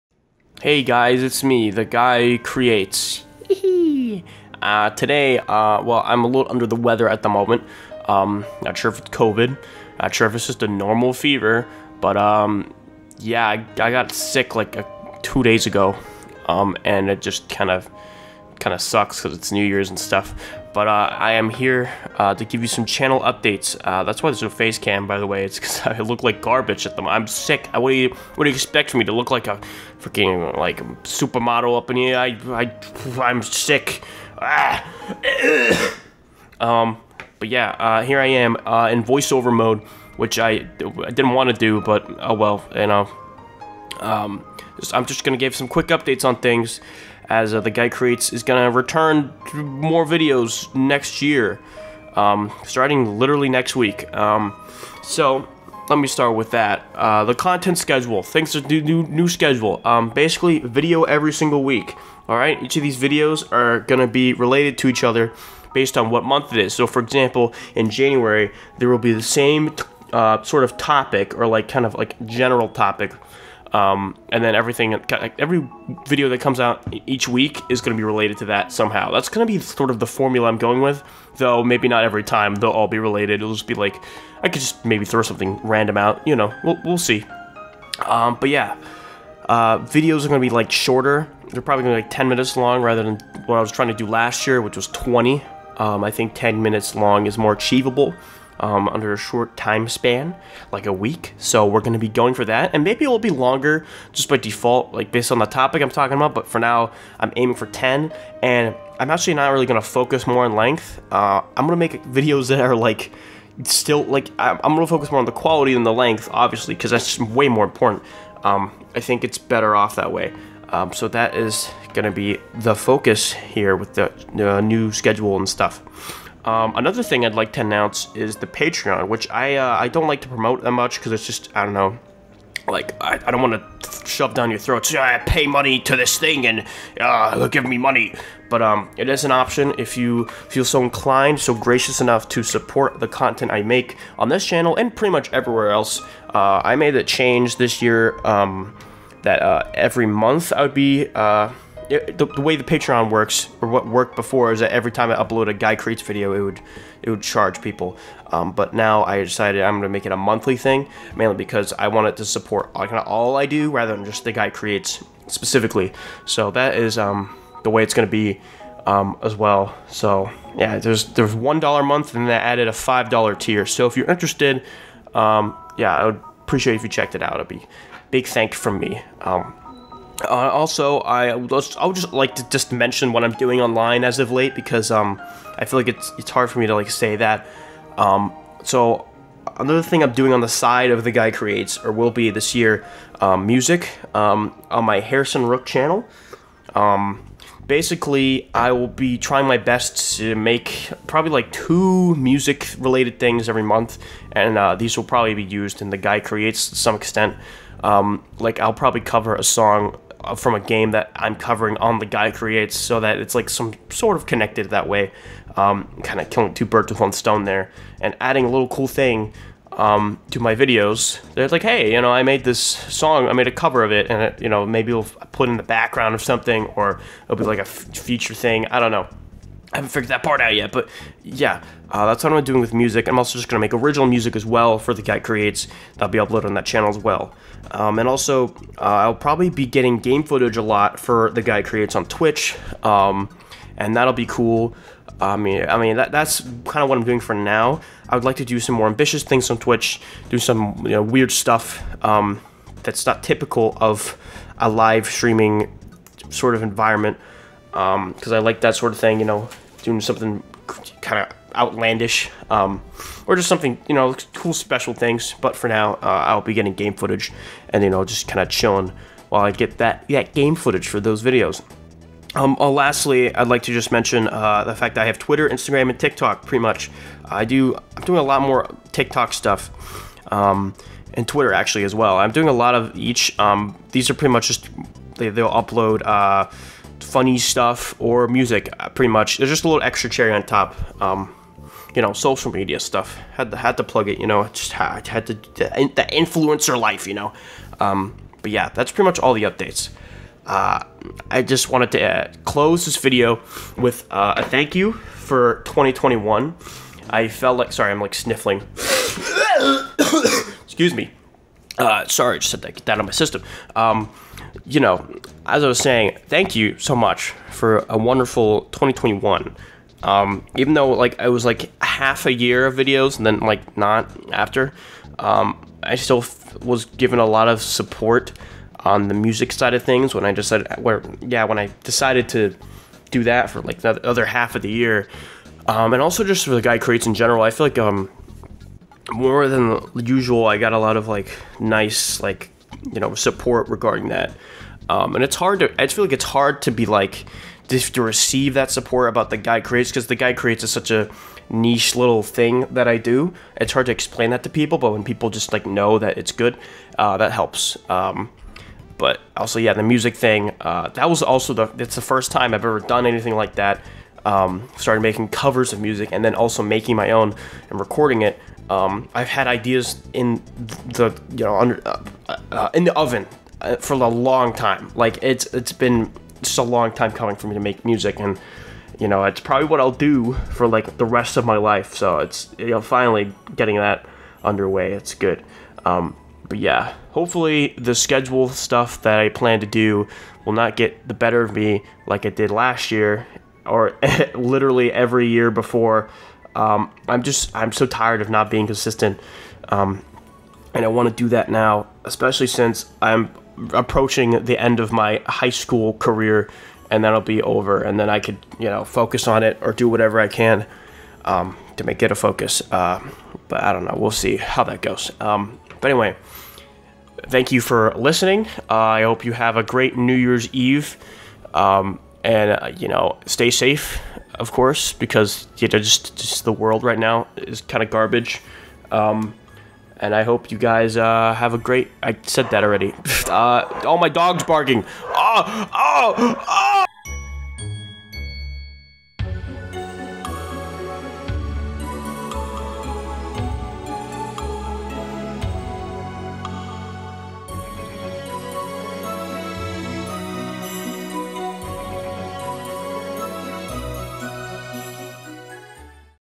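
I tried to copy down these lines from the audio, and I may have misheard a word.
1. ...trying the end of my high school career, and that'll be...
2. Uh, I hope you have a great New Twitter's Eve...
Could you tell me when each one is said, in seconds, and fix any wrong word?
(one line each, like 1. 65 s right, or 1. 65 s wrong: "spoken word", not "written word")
1. 403 s wrong: "approaching", not "trying"
2. 418 s wrong: "Year", not "Twitter".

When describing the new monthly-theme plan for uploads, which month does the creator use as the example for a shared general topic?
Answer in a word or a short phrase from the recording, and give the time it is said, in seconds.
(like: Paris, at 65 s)
January, at 67 s.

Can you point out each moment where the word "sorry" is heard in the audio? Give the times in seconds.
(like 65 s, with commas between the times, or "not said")
307 s, 312 s.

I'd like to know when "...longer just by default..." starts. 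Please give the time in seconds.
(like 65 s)
103 s.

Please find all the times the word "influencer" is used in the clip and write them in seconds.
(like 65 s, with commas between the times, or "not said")
296 s.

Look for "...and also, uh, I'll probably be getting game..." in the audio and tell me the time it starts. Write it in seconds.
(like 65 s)
237 s.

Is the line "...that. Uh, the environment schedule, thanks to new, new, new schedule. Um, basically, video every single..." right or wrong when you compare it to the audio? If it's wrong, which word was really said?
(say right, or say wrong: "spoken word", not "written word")
wrong: "content", not "environment".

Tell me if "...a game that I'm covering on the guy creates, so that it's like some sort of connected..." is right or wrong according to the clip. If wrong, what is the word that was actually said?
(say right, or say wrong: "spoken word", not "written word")
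right.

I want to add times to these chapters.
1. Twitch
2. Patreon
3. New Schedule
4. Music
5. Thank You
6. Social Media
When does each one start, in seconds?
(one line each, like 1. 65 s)
1. 237 s
2. 126 s
3. 55 s
4. 190 s
5. 300 s
6. 272 s.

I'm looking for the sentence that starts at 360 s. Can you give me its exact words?
Uh, that was also the it's the first time I've ever done anything like that.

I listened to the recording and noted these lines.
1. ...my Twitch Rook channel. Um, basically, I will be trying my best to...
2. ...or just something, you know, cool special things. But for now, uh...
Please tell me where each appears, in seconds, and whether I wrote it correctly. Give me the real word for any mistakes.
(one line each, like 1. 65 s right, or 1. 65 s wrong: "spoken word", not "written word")
1. 194 s wrong: "Harrison", not "Twitch"
2. 263 s right.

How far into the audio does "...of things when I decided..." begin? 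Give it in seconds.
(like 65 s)
329 s.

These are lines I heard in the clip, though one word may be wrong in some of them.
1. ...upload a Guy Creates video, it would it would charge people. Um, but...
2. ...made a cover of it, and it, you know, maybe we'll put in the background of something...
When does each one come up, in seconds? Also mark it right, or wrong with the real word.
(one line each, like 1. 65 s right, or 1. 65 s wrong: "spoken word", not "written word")
1. 155 s right
2. 223 s right.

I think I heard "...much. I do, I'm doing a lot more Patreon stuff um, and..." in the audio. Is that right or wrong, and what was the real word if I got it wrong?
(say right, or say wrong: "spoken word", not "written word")
wrong: "TikTok", not "Patreon".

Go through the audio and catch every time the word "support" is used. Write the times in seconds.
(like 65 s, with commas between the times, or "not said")
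142 s, 162 s, 327 s, 343 s, 348 s.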